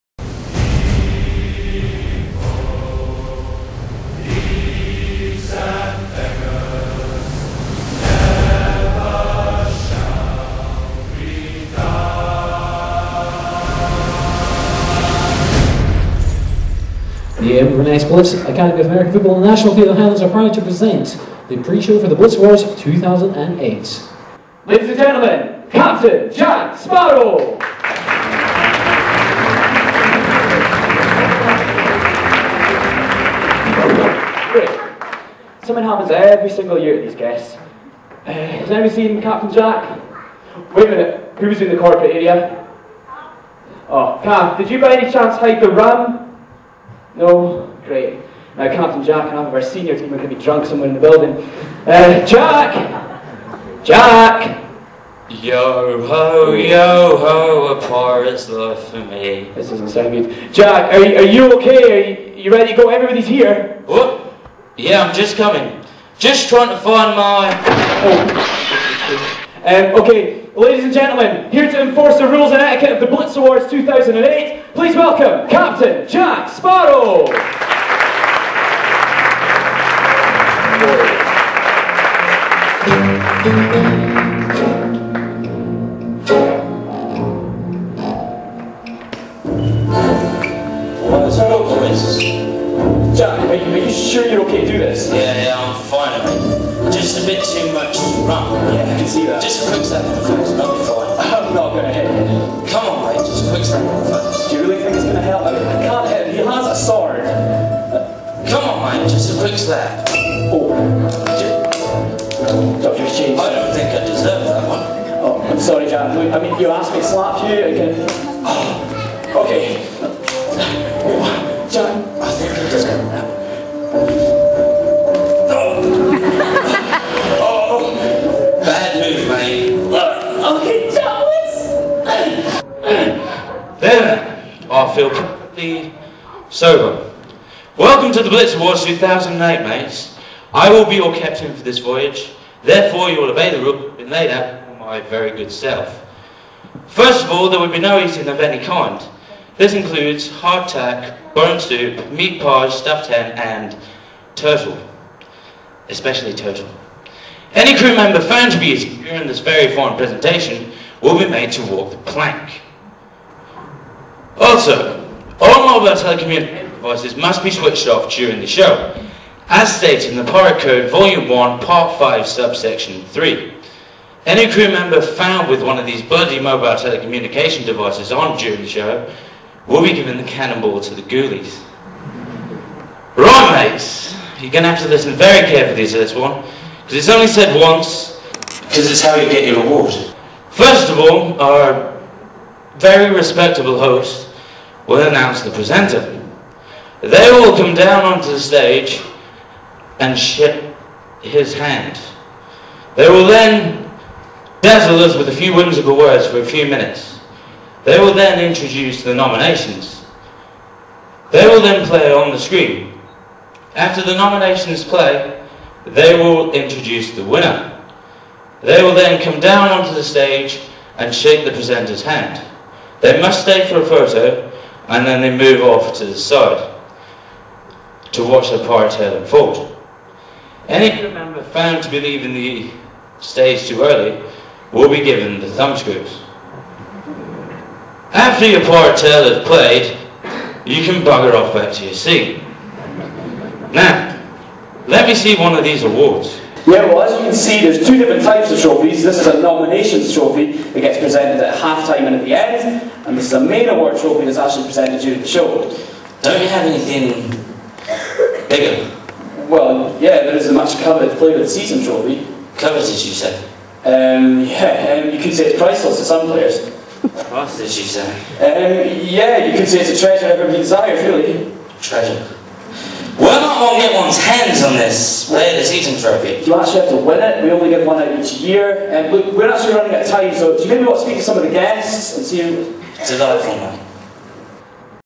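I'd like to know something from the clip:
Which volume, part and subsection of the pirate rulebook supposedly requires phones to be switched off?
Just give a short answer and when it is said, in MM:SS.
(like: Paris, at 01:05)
Volume 1, Part 5, Subsection 3, at 02:50.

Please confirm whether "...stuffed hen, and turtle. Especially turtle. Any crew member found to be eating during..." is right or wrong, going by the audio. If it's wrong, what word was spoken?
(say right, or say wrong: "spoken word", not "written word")
right.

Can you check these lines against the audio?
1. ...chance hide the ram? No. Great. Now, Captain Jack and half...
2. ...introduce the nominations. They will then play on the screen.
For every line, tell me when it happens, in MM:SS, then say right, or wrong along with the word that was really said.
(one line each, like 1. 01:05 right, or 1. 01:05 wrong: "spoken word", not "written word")
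1. 00:45 right
2. 03:28 right.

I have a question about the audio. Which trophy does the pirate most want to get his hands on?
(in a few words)
Player of the season trophy.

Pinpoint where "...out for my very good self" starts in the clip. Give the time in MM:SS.
02:24.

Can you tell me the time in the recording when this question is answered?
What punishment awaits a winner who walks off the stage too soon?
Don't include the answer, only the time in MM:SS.
03:55.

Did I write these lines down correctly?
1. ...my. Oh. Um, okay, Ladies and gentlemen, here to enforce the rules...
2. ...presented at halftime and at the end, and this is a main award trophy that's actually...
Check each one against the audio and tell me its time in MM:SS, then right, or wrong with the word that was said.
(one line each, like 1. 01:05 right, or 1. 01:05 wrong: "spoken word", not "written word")
1. 01:07 right
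2. 04:10 right.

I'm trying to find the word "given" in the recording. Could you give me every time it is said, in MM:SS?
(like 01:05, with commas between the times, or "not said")
02:59, 03:55.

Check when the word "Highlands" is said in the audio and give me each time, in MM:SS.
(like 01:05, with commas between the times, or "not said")
00:19.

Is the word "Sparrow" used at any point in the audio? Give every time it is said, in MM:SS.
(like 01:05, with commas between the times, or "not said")
00:26, 01:16.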